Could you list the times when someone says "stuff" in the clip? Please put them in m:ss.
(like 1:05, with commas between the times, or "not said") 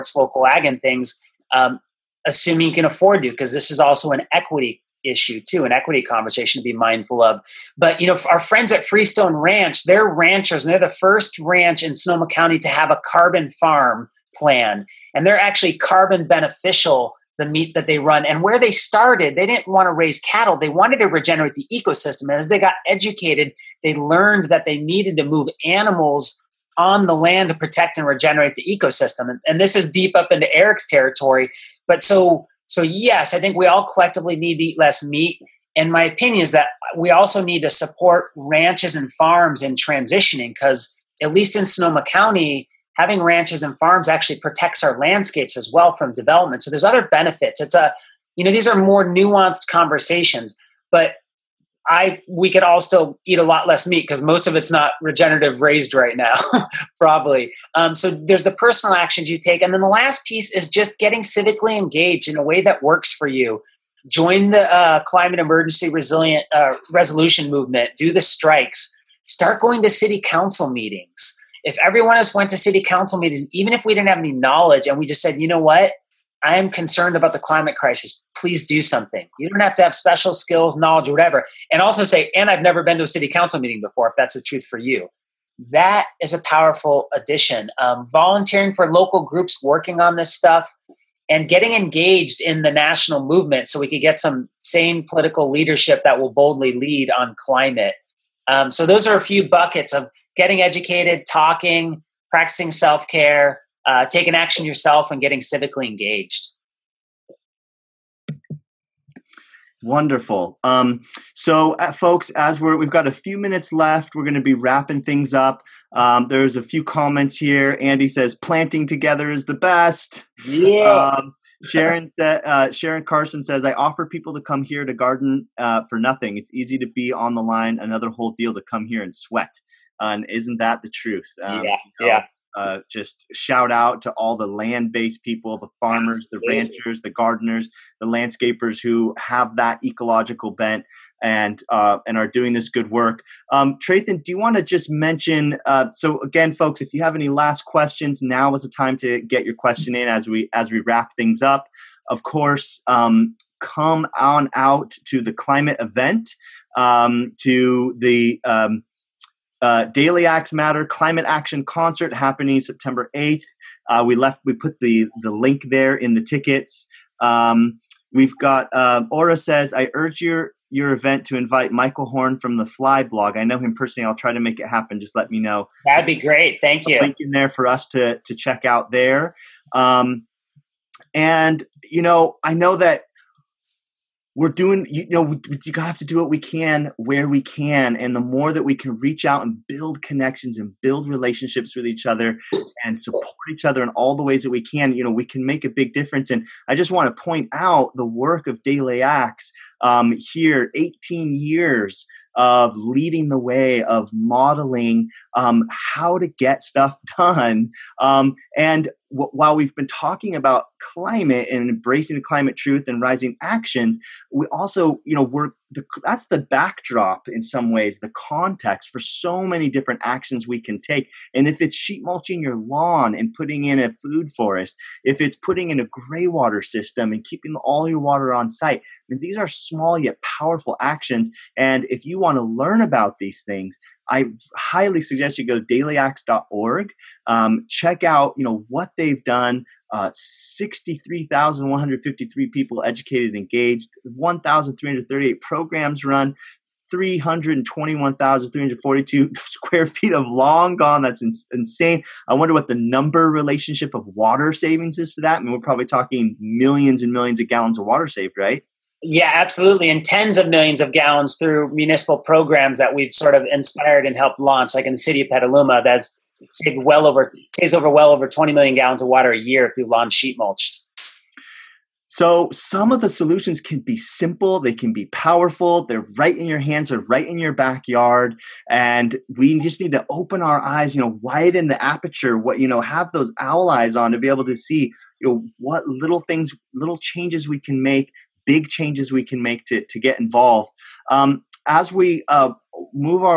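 1:30, 3:26.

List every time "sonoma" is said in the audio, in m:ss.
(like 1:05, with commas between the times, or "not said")
0:11, 0:41.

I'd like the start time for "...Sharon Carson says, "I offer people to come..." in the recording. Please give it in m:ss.
2:02.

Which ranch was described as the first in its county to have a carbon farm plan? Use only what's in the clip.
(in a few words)
Freestone Ranch.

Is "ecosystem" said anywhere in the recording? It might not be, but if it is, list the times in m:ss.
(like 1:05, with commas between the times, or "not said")
0:21, 0:28.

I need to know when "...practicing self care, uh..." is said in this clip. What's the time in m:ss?
1:42.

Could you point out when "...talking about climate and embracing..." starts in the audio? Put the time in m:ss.
3:29.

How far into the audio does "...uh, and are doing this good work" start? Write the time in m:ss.
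2:21.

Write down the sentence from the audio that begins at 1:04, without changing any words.
Join the uh, climate emergency resilient uh, resolution movement.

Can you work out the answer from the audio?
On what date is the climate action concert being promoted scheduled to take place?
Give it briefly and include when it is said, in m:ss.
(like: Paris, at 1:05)
September 8th, at 2:42.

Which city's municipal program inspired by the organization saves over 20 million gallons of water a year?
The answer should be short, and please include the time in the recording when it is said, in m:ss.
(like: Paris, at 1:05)
Petaluma, at 4:25.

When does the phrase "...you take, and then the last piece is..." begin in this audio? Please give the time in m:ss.
0:59.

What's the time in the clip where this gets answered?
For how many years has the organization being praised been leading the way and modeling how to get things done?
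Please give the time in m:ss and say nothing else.
3:20.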